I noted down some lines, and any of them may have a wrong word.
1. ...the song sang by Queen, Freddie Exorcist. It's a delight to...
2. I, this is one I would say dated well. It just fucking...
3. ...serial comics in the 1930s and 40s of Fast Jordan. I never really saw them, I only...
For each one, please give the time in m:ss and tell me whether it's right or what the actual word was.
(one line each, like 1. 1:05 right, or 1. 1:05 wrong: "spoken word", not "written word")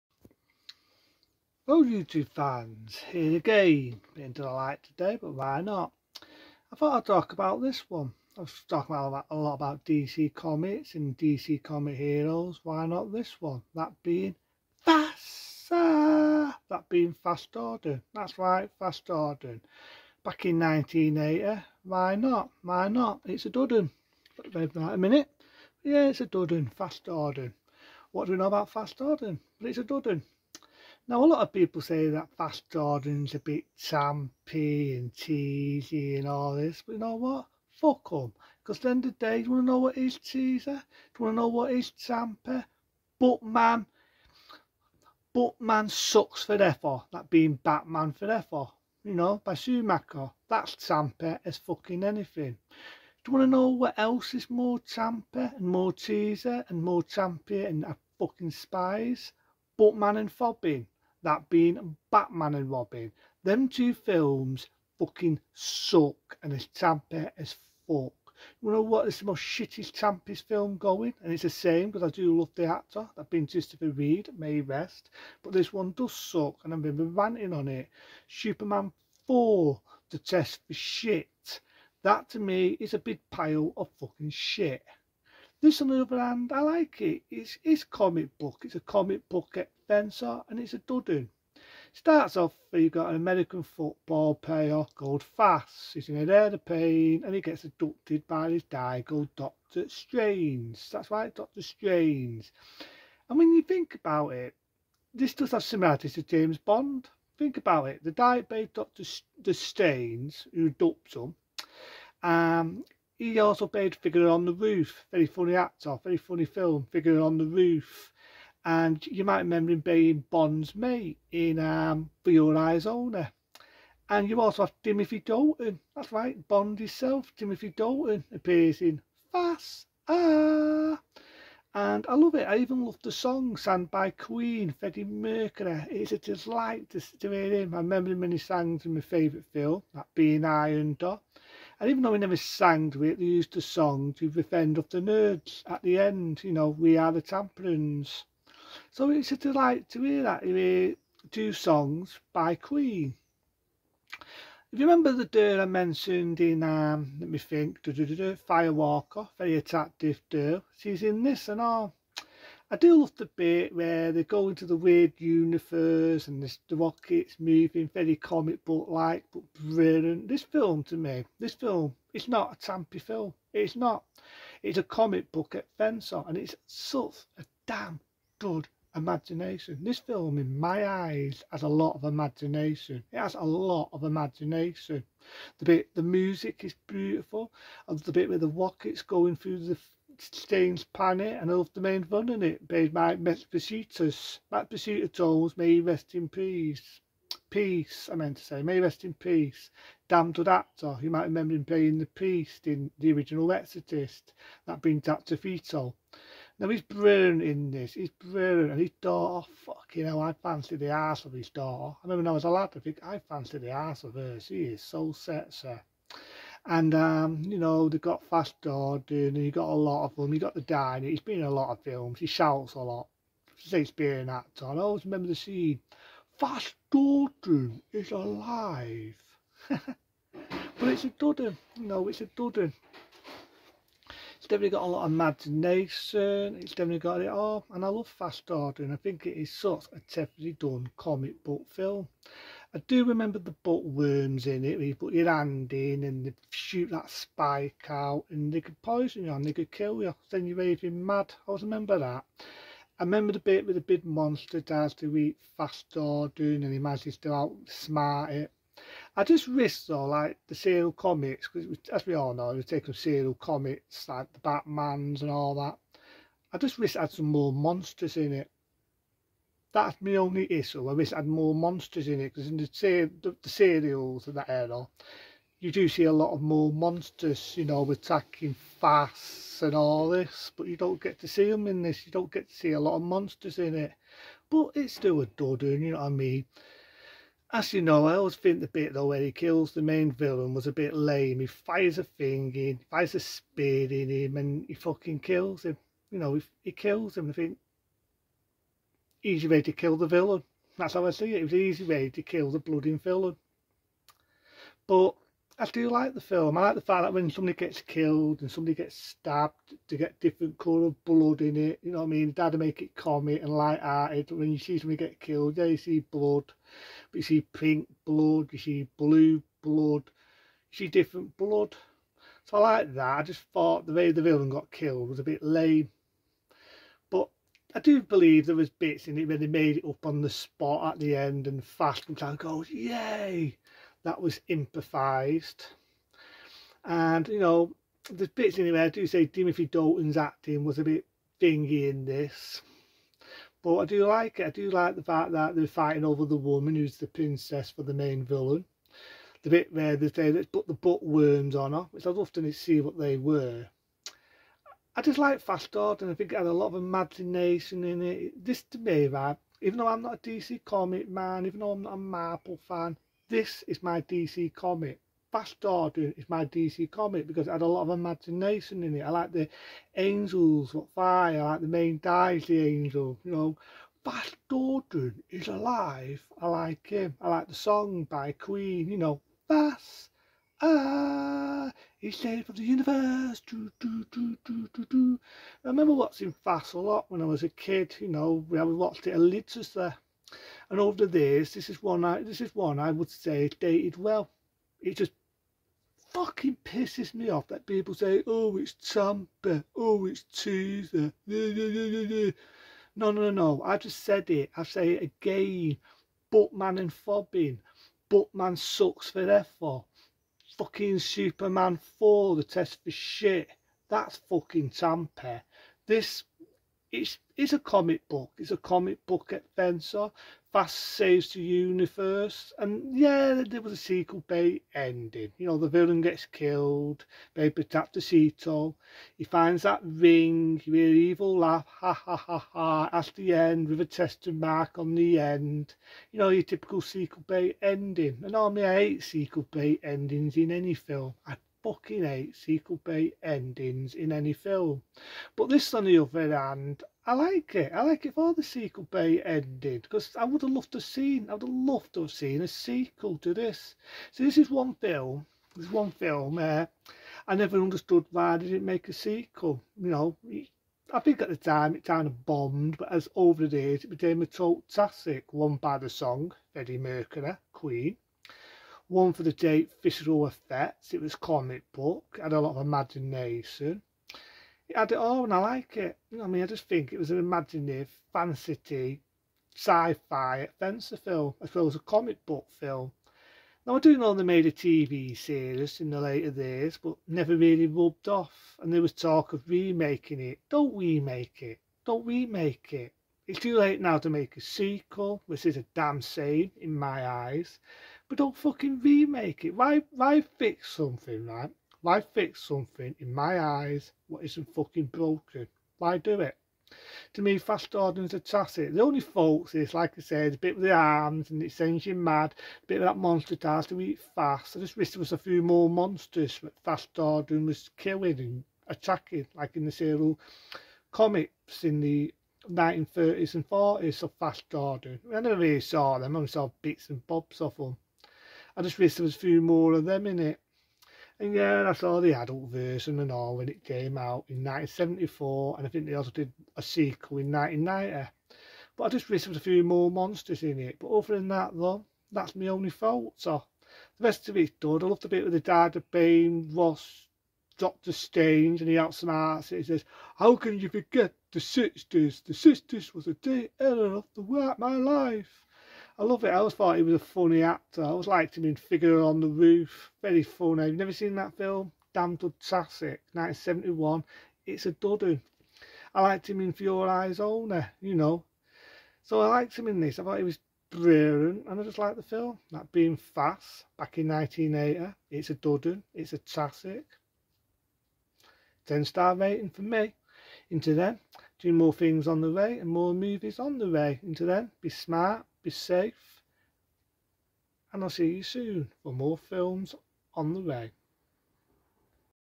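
1. 2:13 wrong: "Mercury", not "Exorcist"
2. 6:32 right
3. 8:39 right.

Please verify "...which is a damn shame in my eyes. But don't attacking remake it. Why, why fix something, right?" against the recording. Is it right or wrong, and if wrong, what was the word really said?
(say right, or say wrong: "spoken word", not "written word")
wrong: "fucking", not "attacking".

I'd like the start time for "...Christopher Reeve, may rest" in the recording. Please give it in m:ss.
1:13.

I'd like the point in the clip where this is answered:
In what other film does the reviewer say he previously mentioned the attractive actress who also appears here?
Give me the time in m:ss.
2:37.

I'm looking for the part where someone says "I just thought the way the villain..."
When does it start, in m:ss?
5:23.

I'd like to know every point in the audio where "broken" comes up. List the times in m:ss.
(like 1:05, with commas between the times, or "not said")
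8:24.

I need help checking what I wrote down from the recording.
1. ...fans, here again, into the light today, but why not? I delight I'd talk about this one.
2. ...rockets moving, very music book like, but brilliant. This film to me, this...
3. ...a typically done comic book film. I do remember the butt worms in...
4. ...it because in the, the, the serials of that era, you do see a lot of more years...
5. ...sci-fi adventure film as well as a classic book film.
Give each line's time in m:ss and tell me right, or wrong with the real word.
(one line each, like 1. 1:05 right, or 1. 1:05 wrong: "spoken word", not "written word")
1. 0:02 wrong: "thought", not "delight"
2. 2:46 wrong: "comic", not "music"
3. 3:59 right
4. 4:32 wrong: "monsters", not "years"
5. 7:59 wrong: "comic", not "classic".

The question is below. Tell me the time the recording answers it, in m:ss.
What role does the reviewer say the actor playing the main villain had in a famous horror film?
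3:21.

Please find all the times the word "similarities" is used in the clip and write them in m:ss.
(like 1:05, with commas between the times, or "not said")
1:45.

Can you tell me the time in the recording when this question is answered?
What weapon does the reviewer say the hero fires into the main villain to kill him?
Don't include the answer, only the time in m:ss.
4:53.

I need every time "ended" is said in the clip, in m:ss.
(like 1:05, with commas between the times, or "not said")
7:29.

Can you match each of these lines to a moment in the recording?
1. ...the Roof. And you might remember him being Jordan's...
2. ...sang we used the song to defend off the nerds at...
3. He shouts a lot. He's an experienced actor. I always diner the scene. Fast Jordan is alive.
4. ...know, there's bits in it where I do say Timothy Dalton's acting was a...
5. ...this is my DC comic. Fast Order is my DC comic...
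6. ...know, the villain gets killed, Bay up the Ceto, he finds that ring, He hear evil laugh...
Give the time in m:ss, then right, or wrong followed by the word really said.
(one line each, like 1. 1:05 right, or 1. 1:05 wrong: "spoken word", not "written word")
1. 1:57 wrong: "Bond", not "Jordan"
2. 2:22 right
3. 3:42 wrong: "remember", not "diner"
4. 5:37 right
5. 6:03 right
6. 7:05 right.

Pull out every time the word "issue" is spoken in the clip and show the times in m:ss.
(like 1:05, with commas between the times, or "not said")
4:30.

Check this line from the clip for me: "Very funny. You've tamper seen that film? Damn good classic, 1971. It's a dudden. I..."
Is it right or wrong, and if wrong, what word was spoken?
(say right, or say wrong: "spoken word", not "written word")
wrong: "never", not "tamper".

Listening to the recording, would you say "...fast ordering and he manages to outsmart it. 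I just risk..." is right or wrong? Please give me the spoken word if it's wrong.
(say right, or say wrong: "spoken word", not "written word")
right.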